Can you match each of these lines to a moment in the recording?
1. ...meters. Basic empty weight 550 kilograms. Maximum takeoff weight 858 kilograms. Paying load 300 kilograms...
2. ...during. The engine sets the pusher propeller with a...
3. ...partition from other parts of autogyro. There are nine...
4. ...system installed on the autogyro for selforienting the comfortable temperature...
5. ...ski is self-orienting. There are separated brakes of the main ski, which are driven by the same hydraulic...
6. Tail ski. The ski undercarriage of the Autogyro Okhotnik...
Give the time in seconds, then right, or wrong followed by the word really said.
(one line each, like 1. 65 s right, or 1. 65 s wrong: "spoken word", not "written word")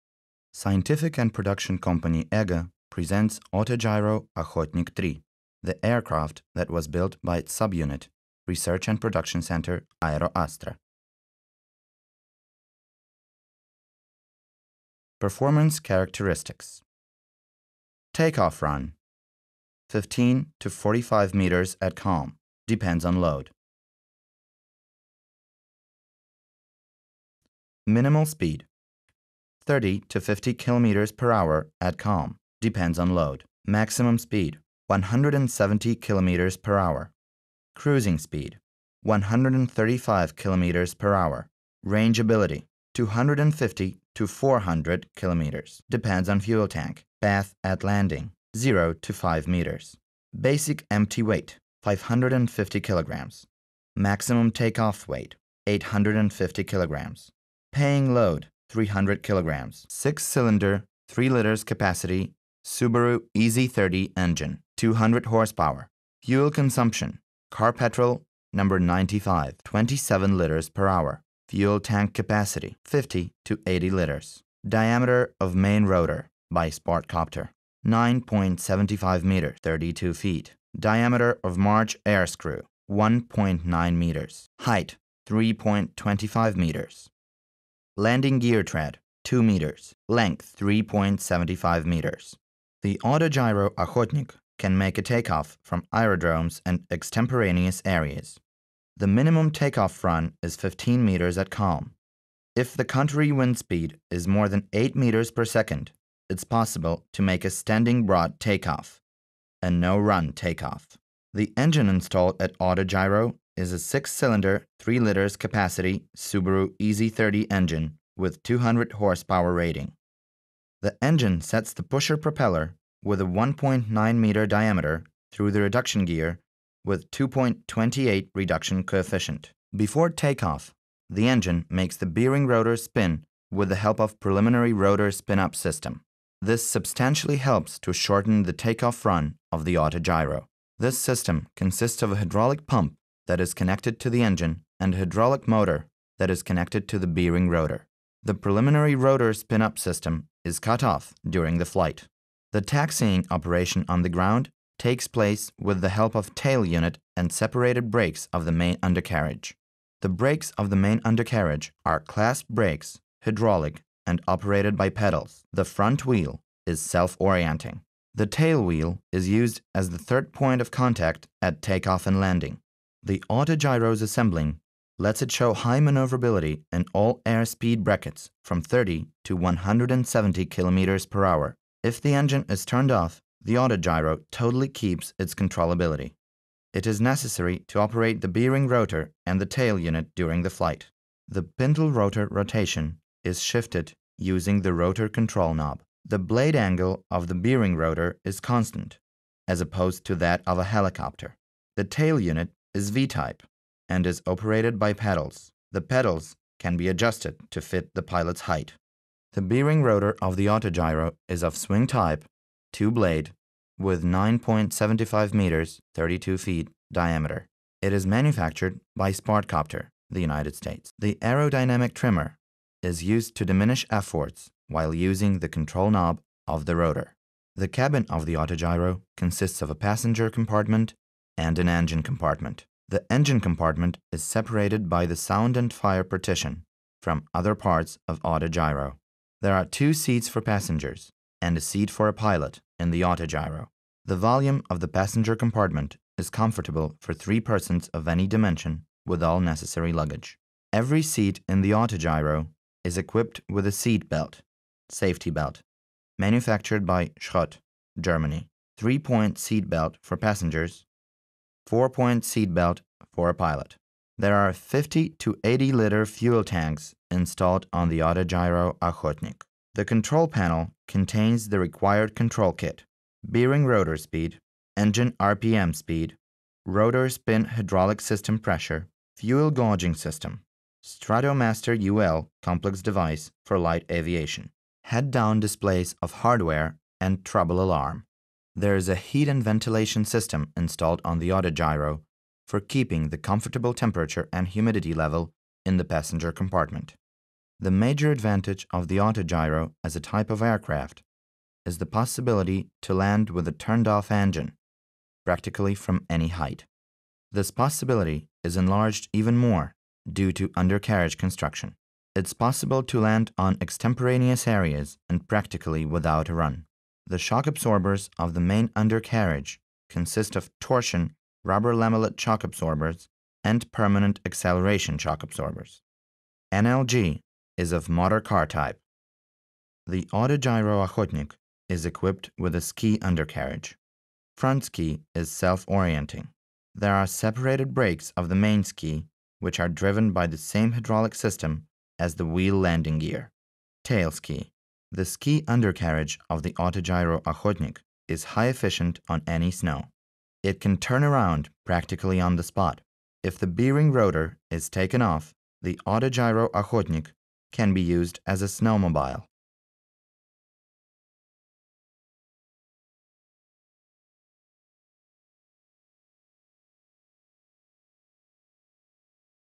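1. 49 s wrong: "850", not "858"
2. 119 s wrong: "rating", not "during"
3. 236 s wrong: "two", not "nine"
4. 290 s wrong: "keeping", not "selforienting"
5. 334 s right
6. 343 s right.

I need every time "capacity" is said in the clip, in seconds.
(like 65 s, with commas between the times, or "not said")
61 s, 72 s, 115 s.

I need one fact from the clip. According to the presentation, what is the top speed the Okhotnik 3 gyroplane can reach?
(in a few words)
170 km/h.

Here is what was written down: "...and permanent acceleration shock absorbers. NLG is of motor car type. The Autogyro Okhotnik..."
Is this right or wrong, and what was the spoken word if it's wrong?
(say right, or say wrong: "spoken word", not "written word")
right.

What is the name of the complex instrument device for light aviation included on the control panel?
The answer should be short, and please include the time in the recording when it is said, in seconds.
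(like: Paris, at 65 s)
Stratomaster UL, at 280 s.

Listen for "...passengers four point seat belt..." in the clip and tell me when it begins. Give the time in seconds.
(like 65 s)
260 s.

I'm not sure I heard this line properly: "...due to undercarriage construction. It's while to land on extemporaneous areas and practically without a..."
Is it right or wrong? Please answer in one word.
wrong.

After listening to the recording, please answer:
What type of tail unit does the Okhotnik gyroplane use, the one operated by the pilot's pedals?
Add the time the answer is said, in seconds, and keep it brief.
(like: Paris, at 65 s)
V-type, at 202 s.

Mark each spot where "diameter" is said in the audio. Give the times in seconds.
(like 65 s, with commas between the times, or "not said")
74 s, 80 s, 124 s, 216 s.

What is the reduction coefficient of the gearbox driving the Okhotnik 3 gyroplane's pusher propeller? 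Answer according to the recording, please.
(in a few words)
2.28.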